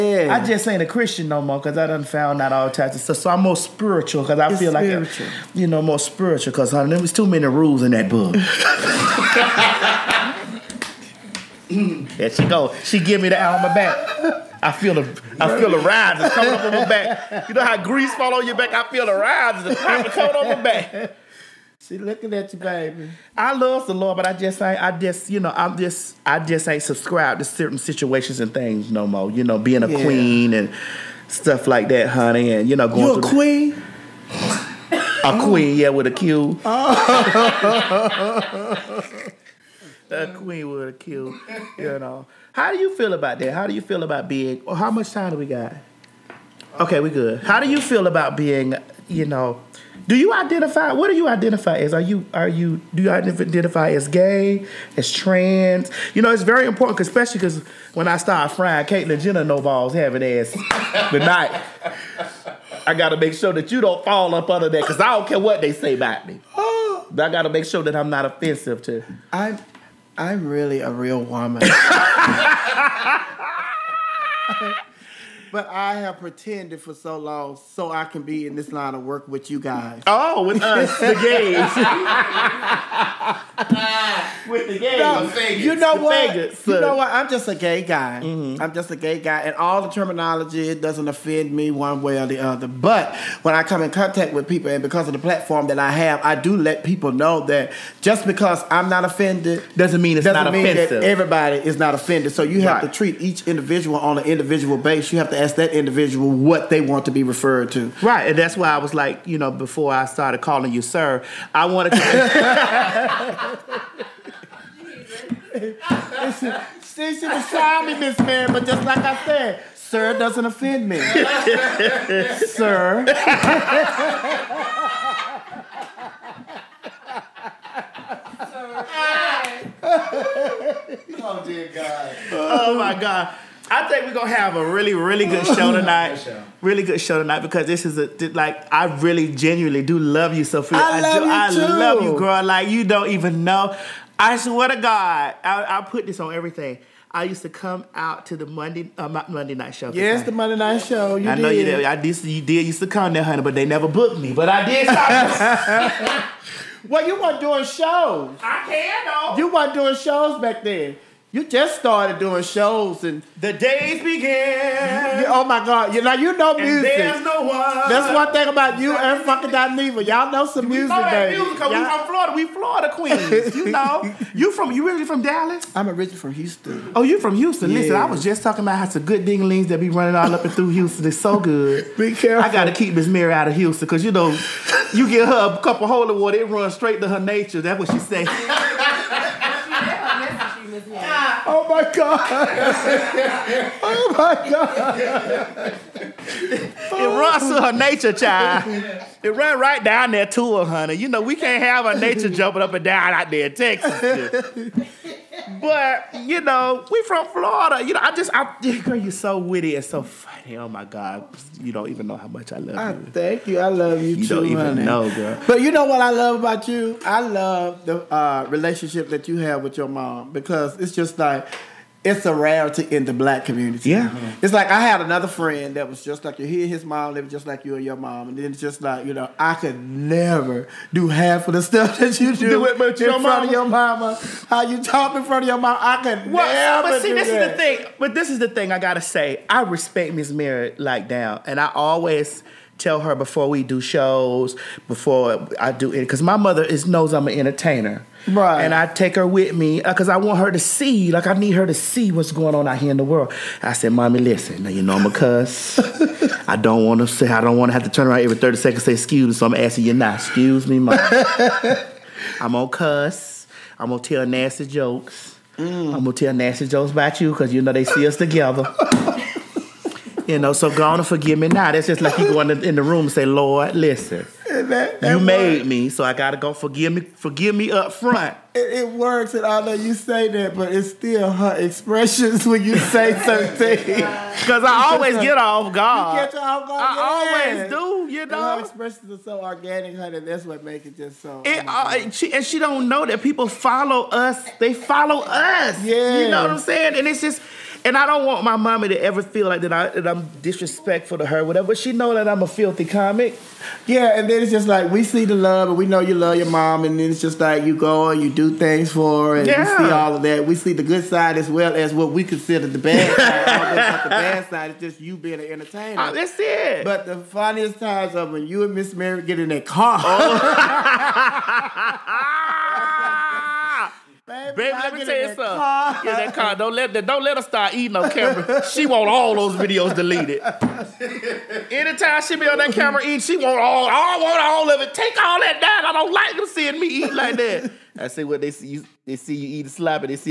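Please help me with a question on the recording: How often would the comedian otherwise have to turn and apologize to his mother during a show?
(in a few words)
every 30 seconds.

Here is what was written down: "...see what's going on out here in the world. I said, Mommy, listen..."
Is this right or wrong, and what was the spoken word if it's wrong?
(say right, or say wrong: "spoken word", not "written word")
right.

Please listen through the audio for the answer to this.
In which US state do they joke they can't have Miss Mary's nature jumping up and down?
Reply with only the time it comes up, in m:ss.
3:23.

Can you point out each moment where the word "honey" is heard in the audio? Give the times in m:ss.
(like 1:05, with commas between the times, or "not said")
0:06, 0:32, 2:33, 3:20, 3:34, 4:49.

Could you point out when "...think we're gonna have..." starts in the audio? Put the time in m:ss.
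2:13.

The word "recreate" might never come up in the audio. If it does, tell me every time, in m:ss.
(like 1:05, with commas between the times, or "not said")
not said.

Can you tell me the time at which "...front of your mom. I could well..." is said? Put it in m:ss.
3:55.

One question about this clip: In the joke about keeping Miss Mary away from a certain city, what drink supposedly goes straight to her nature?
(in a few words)
holy water.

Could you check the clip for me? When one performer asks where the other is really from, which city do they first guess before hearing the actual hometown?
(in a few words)
Dallas.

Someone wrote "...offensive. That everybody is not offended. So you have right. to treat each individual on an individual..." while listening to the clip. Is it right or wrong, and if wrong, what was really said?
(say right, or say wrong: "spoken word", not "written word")
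right.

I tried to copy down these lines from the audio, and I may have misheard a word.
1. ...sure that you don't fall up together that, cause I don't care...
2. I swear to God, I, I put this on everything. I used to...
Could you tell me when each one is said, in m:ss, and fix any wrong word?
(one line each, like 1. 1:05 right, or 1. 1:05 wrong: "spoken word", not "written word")
1. 1:03 wrong: "under", not "together"
2. 2:24 right.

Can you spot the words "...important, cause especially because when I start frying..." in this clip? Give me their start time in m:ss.
0:56.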